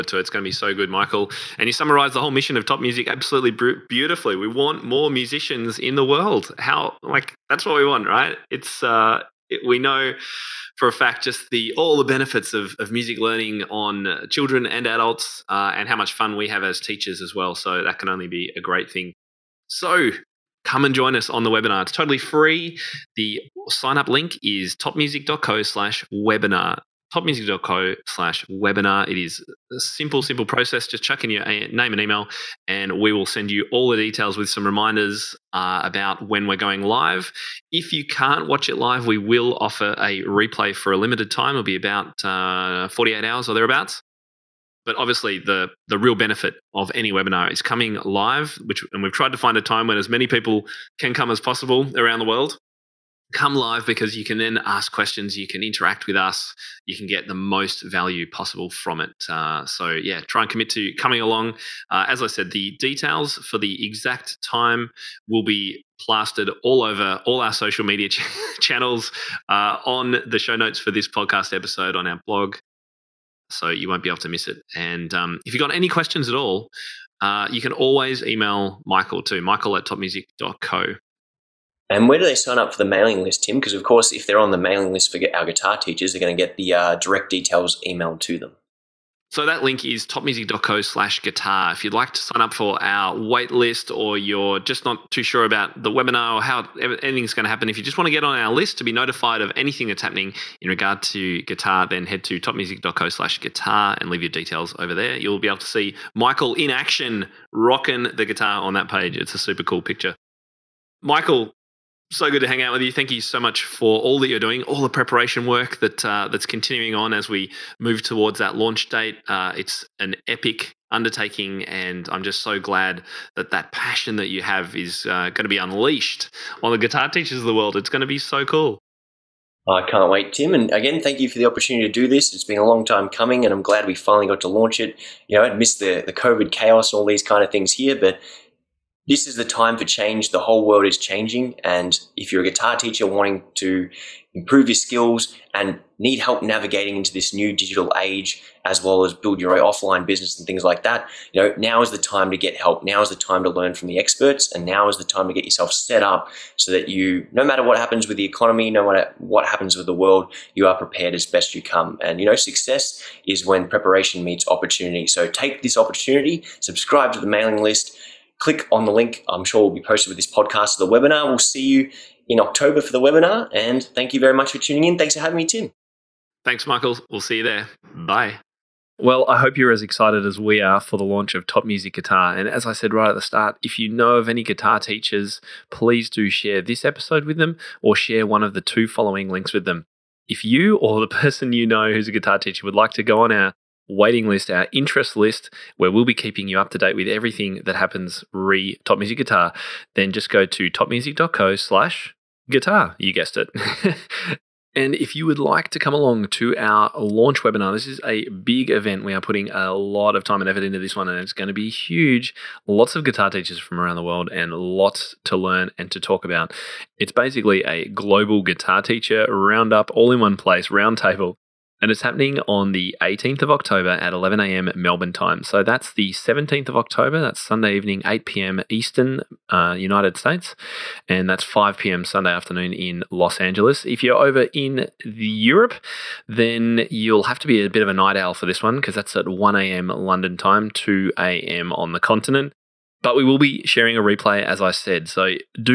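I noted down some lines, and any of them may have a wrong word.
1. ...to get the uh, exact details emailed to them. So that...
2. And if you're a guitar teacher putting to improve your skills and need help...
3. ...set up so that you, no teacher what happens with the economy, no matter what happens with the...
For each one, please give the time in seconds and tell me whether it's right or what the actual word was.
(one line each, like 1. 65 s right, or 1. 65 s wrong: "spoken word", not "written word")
1. 86 s wrong: "direct", not "exact"
2. 141 s wrong: "wanting", not "putting"
3. 155 s wrong: "matter", not "teacher".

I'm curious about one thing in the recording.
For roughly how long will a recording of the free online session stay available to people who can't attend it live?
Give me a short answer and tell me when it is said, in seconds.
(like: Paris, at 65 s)
48 hours, at 42 s.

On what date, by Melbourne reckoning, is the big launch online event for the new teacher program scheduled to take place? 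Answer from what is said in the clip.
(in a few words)
18 October.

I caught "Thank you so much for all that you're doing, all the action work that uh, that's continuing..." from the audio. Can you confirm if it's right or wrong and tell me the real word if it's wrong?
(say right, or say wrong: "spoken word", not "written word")
wrong: "preparation", not "action".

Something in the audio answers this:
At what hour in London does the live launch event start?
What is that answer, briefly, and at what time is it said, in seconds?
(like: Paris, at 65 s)
1 a.m., at 239 s.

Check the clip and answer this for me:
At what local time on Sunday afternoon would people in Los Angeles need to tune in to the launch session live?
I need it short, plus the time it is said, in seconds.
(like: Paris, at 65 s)
5 p.m., at 231 s.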